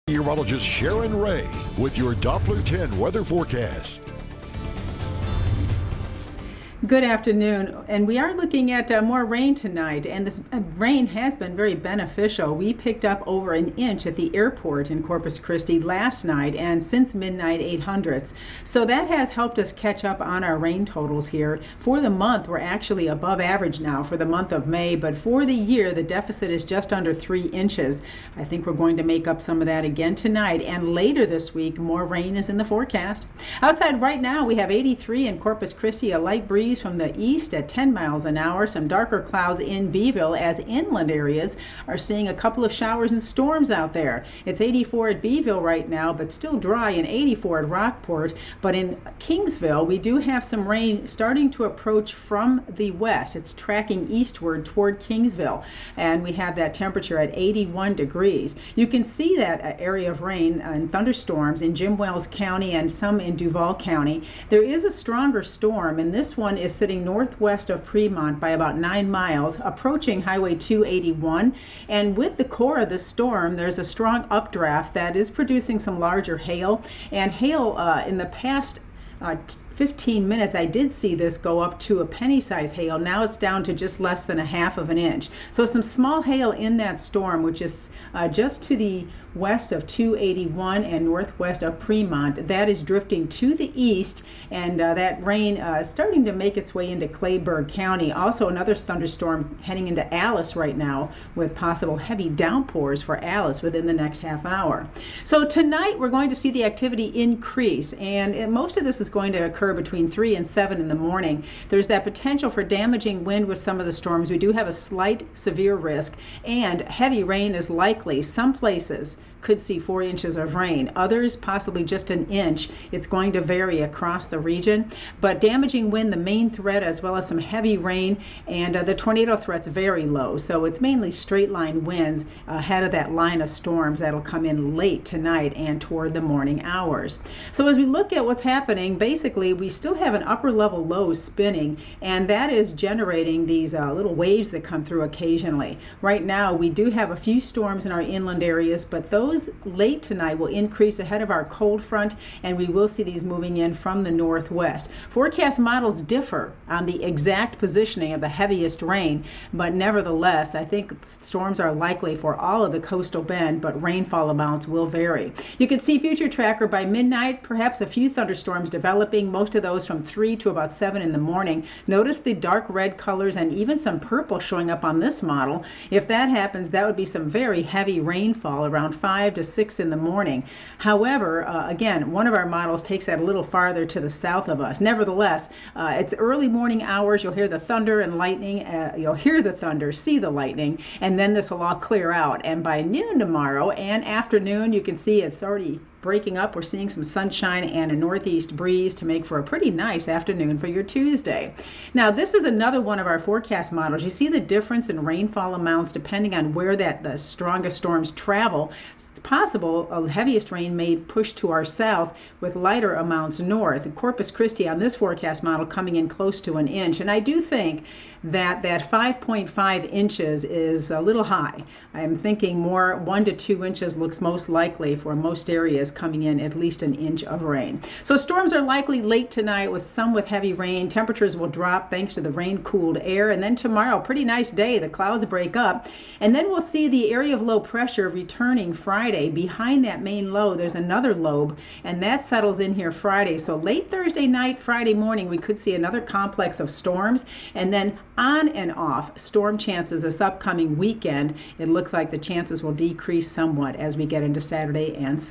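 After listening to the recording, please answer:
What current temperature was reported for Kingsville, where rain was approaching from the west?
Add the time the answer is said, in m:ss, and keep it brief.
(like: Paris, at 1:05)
81 degrees, at 0:57.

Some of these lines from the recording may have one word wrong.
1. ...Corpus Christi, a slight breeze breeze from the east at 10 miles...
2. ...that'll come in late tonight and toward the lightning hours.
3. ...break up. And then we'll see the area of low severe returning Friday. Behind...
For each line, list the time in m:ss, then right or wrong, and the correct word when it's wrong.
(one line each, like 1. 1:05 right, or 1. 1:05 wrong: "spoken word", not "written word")
1. 0:35 wrong: "light", not "slight"
2. 2:13 wrong: "morning", not "lightning"
3. 3:55 wrong: "pressure", not "severe".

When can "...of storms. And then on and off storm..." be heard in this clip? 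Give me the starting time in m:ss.
4:06.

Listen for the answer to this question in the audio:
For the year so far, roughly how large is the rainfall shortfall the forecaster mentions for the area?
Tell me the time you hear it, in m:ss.
0:26.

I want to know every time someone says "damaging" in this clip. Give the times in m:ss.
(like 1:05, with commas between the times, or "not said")
1:52, 2:05.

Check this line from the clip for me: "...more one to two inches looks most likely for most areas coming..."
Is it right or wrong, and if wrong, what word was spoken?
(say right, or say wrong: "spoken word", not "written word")
right.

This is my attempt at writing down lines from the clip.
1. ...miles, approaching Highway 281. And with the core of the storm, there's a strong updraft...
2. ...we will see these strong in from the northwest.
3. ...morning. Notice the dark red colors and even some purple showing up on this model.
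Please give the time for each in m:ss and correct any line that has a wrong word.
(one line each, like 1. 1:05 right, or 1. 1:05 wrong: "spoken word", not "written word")
1. 1:09 right
2. 2:32 wrong: "moving", not "strong"
3. 2:51 right.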